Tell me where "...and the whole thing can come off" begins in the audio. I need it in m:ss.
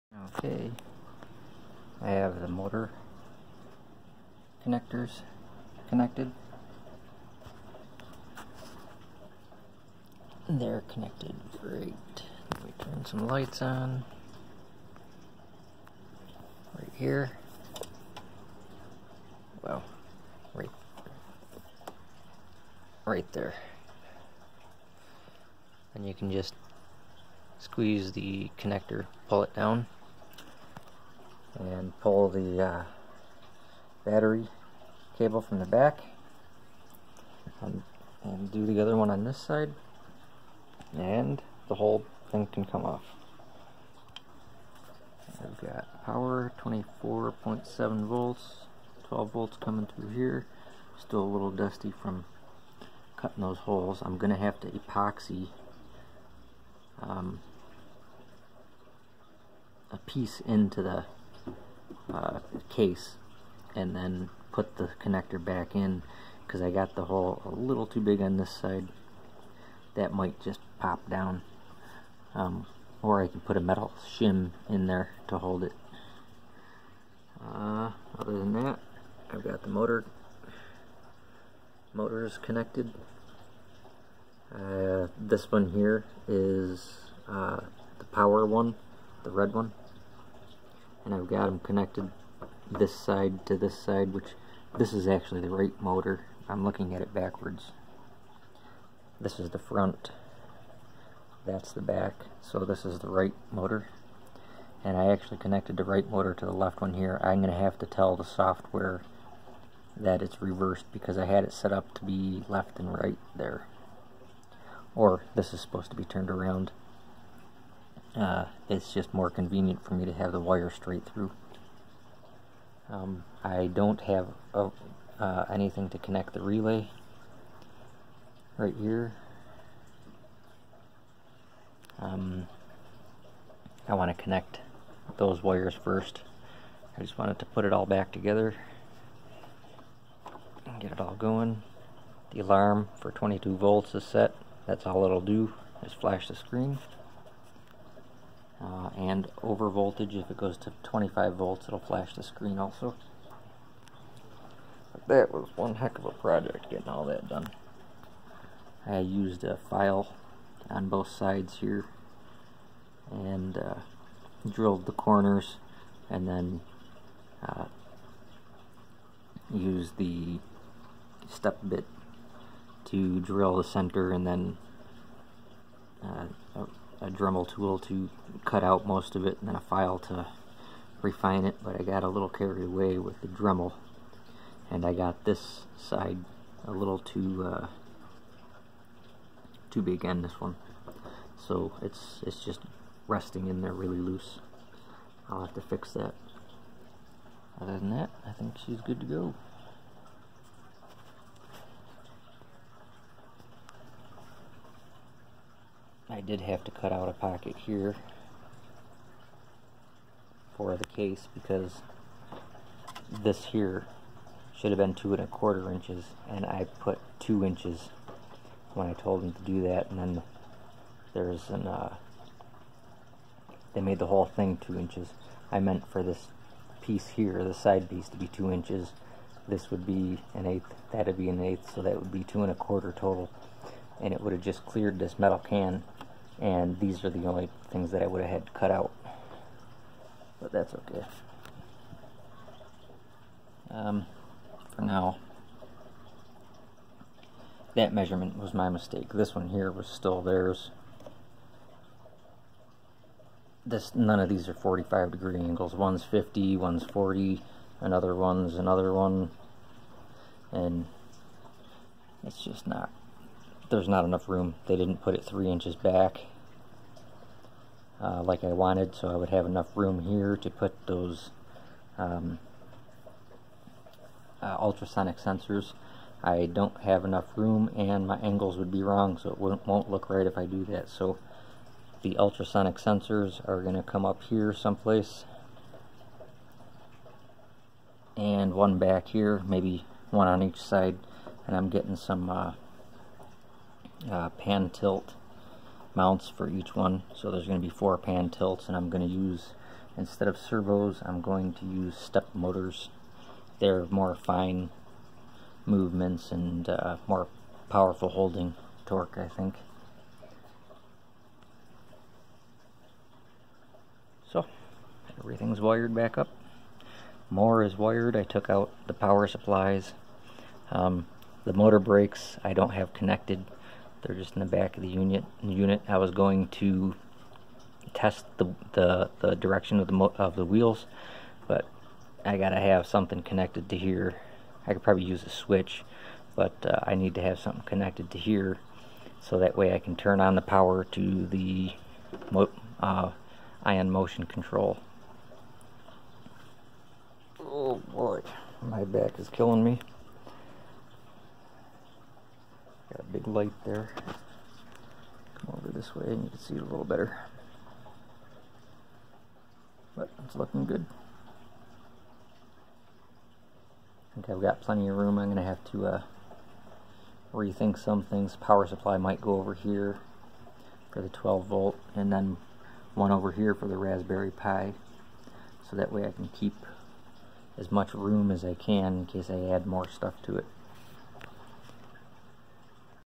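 0:40.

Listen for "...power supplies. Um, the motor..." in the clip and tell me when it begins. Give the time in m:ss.
5:18.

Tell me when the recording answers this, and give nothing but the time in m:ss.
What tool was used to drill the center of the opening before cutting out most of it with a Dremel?
2:51.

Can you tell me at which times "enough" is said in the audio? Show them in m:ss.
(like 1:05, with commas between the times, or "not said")
4:24, 4:29, 4:37.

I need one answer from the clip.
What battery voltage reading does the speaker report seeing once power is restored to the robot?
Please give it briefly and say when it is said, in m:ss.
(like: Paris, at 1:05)
24.7 volts, at 0:46.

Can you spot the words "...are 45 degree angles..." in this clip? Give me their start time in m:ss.
4:14.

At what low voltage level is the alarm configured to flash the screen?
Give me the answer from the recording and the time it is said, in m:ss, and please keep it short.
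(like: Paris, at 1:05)
22 volts, at 2:23.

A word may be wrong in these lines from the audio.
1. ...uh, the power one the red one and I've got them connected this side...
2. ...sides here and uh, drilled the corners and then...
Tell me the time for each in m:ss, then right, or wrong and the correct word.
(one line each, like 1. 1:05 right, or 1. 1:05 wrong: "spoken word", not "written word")
1. 1:27 right
2. 2:41 right.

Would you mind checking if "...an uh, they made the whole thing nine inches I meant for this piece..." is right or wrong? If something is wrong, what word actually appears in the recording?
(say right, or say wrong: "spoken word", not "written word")
wrong: "two", not "nine".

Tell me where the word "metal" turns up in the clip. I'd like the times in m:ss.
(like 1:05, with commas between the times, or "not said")
1:13, 3:55.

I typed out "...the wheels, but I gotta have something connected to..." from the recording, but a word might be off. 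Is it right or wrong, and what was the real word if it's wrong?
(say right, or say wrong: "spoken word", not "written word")
right.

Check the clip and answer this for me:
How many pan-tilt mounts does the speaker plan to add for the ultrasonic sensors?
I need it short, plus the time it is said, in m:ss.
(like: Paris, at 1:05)
4, at 4:57.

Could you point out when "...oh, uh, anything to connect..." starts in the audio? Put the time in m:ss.
2:04.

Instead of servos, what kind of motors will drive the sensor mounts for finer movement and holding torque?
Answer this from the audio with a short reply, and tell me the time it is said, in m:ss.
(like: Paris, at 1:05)
step motors, at 5:01.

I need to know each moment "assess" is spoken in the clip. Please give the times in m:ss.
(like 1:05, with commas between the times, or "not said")
not said.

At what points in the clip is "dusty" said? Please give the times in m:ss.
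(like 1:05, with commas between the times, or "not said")
0:51.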